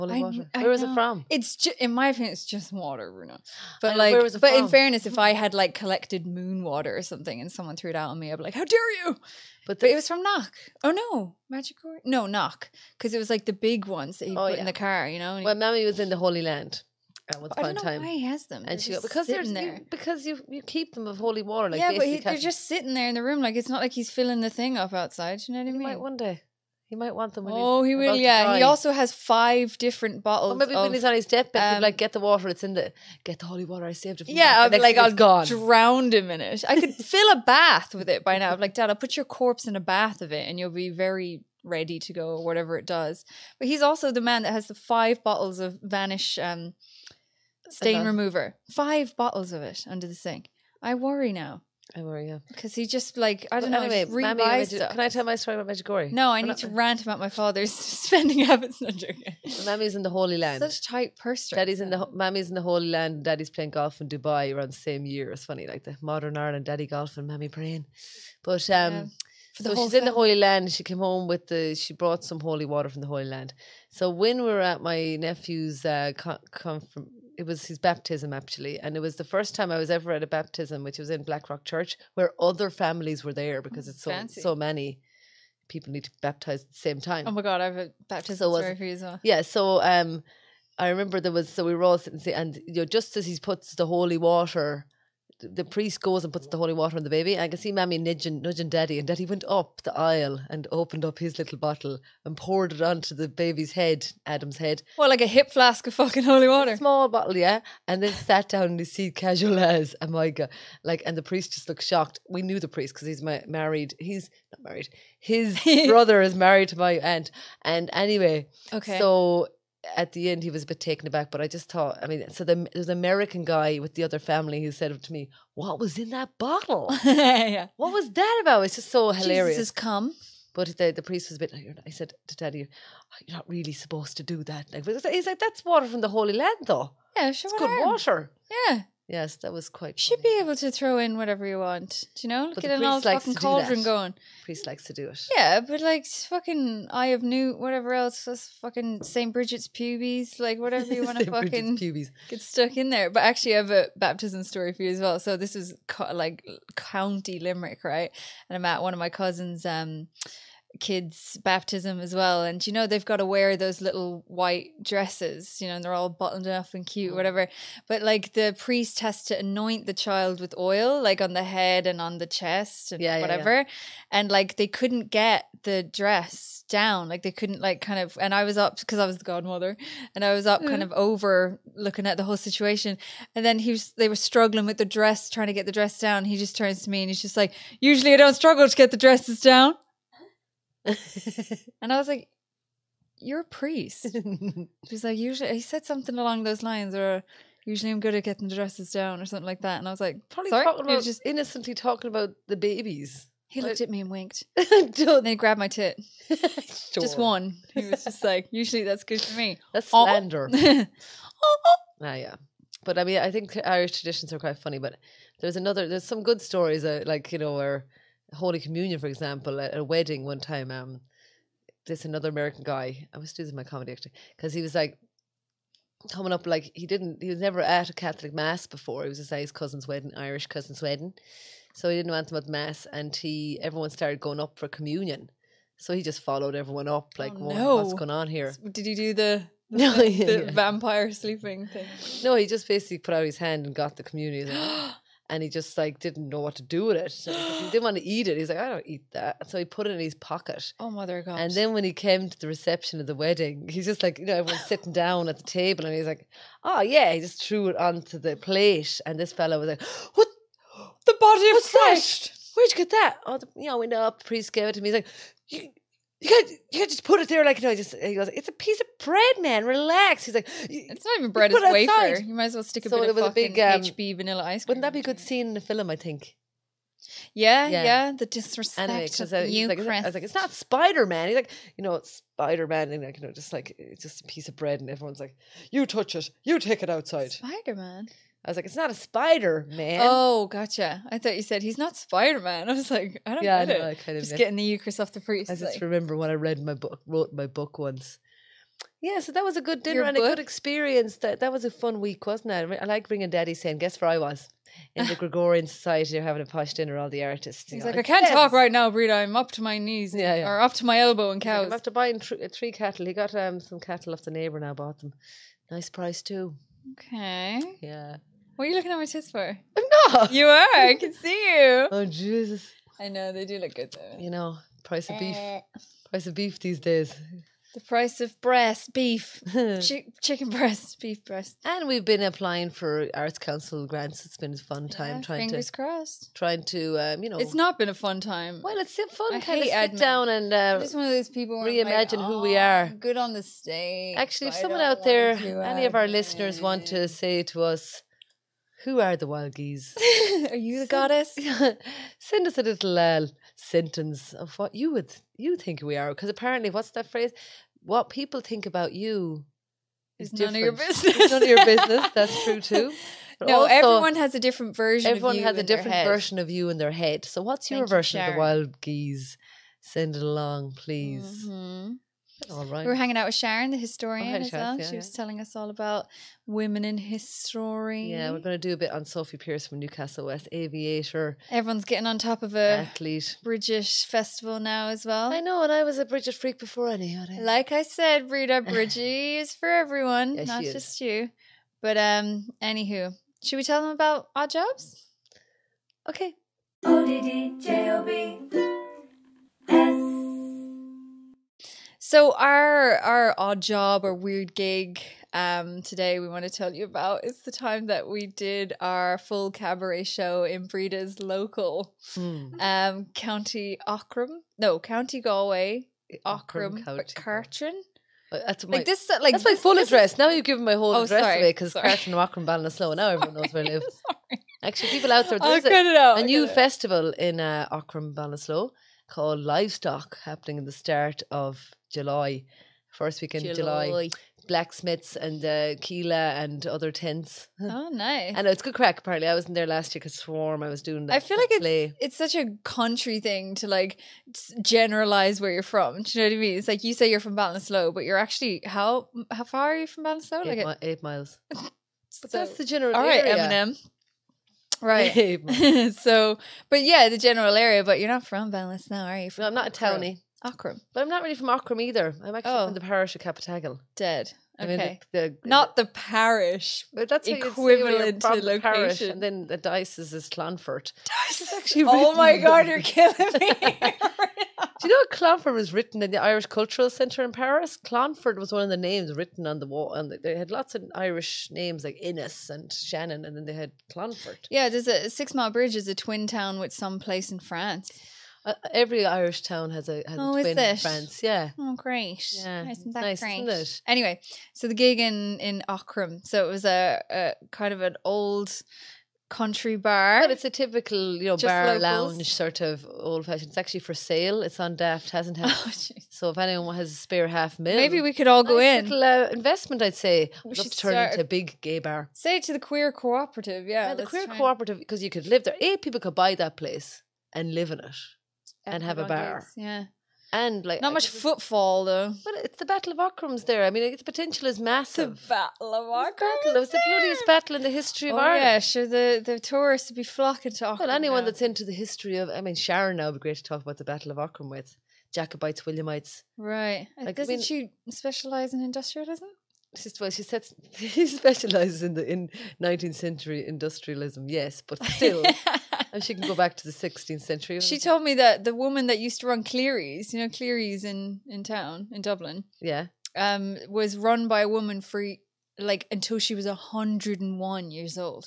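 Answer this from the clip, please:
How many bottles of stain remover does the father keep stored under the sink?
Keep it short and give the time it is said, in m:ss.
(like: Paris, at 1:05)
5, at 0:48.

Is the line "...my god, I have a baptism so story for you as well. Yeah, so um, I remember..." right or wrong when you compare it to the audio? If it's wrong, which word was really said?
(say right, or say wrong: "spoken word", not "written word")
right.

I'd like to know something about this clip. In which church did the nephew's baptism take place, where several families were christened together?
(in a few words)
Blackrock Church.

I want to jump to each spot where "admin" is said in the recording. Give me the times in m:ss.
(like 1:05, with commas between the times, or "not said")
not said.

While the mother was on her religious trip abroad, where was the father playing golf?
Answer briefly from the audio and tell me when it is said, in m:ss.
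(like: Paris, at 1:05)
Dubai, at 1:04.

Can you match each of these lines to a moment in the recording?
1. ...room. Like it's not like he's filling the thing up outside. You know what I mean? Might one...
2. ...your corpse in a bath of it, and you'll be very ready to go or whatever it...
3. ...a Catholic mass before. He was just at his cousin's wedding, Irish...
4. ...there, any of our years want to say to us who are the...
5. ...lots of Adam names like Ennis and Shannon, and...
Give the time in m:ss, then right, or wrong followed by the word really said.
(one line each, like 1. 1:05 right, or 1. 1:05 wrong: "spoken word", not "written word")
1. 0:23 right
2. 0:39 right
3. 3:47 right
4. 5:45 wrong: "listeners", not "years"
5. 8:00 wrong: "Irish", not "Adam".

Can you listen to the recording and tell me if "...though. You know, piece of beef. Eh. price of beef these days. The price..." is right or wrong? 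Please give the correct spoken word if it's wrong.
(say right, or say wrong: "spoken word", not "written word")
wrong: "price", not "piece".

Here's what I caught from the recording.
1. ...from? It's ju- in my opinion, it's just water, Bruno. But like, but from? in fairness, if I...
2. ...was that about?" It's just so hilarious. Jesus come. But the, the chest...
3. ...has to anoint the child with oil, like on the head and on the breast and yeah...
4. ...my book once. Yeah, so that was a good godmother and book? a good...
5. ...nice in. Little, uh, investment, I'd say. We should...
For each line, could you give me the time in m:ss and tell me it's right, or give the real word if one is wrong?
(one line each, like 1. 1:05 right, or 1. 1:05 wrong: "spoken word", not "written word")
1. 0:00 right
2. 2:07 wrong: "priest", not "chest"
3. 2:48 wrong: "chest", not "breast"
4. 4:57 wrong: "dinner", not "godmother"
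5. 8:28 right.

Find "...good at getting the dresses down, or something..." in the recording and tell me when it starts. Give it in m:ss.
3:18.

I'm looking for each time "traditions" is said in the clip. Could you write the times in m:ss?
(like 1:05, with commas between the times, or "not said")
3:33.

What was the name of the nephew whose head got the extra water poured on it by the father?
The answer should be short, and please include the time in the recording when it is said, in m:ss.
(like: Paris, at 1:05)
Adam, at 1:44.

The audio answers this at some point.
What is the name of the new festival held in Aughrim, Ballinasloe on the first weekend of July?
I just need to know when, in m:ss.
7:09.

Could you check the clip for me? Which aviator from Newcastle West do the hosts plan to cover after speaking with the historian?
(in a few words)
Sophie Peirce.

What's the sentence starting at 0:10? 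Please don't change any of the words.
Oh no, Magic No, Knock, because it was like the big ones that oh, put yeah.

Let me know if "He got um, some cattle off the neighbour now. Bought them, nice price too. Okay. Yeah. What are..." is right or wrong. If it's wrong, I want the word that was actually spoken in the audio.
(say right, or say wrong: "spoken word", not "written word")
right.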